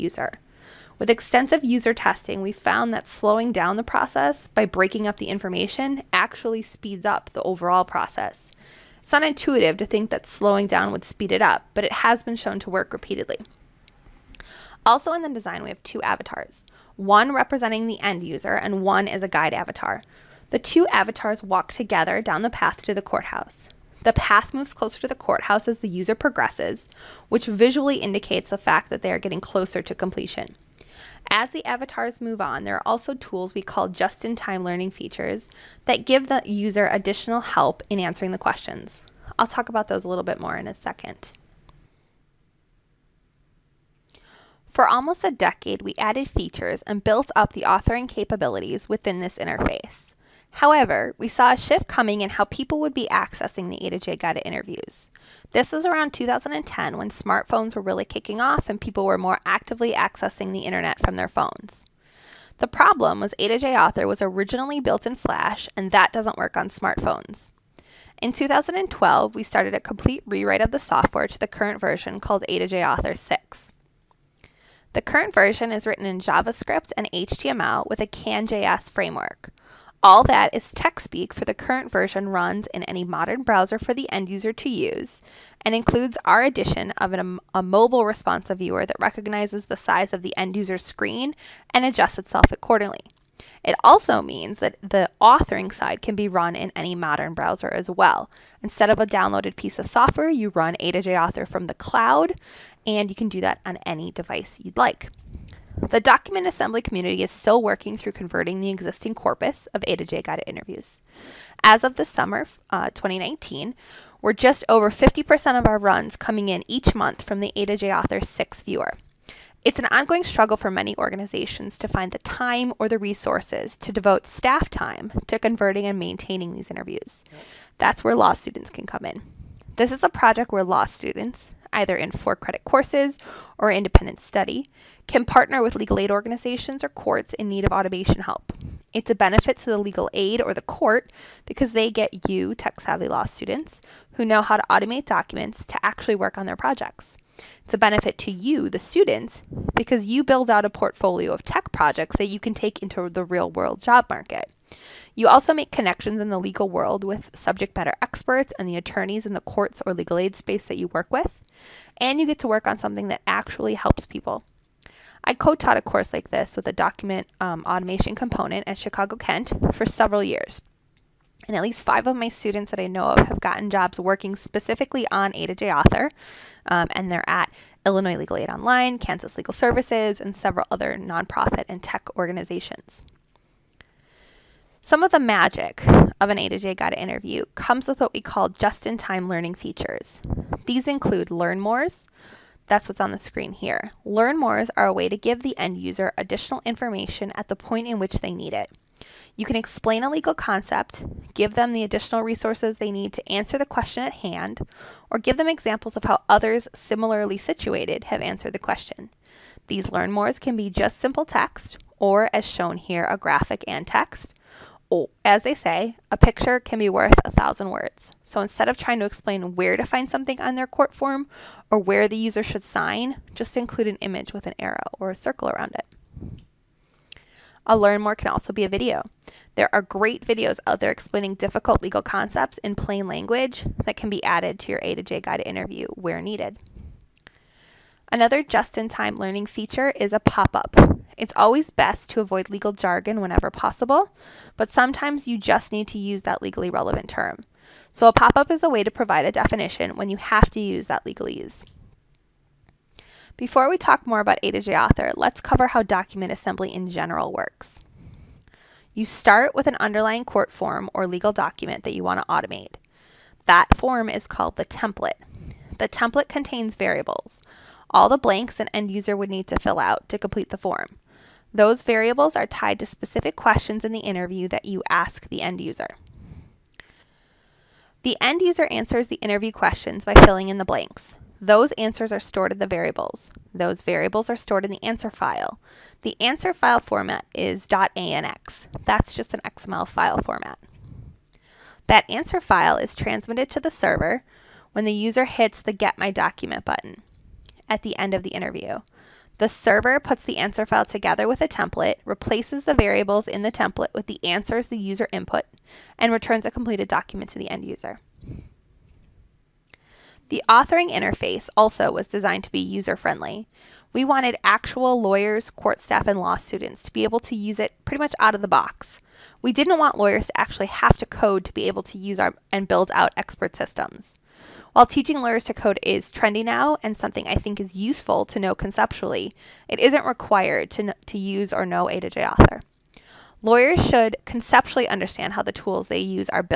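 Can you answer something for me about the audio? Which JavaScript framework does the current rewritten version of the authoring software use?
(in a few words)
CanJS.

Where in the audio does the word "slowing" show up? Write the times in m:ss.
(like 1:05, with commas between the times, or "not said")
0:03, 0:10.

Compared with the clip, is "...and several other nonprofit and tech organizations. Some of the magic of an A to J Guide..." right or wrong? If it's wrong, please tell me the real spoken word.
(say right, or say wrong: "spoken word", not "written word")
right.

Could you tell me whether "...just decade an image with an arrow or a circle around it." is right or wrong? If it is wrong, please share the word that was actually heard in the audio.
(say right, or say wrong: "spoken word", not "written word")
wrong: "include", not "decade".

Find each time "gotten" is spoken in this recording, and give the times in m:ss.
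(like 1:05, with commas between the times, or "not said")
2:53.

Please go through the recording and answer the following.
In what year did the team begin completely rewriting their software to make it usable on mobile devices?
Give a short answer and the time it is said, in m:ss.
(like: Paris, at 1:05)
2012, at 1:08.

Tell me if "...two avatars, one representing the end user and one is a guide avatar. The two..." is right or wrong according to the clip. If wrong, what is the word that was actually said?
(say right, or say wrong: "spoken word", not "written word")
right.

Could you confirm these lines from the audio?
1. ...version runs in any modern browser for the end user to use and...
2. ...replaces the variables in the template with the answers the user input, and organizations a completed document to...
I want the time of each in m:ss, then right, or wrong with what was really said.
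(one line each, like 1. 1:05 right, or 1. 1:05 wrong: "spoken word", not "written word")
1. 1:21 right
2. 5:02 wrong: "returns", not "organizations".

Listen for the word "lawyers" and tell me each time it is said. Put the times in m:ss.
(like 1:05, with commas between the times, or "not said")
5:14, 5:19, 5:25, 5:33.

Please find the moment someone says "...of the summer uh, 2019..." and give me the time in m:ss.
1:51.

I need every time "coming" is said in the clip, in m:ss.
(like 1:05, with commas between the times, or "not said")
0:51, 1:56.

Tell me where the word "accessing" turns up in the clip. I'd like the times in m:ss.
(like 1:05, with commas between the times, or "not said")
0:53, 0:59.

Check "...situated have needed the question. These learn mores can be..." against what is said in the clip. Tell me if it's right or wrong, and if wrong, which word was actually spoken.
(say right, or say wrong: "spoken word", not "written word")
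wrong: "answered", not "needed".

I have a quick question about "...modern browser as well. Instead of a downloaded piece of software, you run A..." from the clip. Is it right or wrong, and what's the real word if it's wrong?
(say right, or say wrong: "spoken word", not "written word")
right.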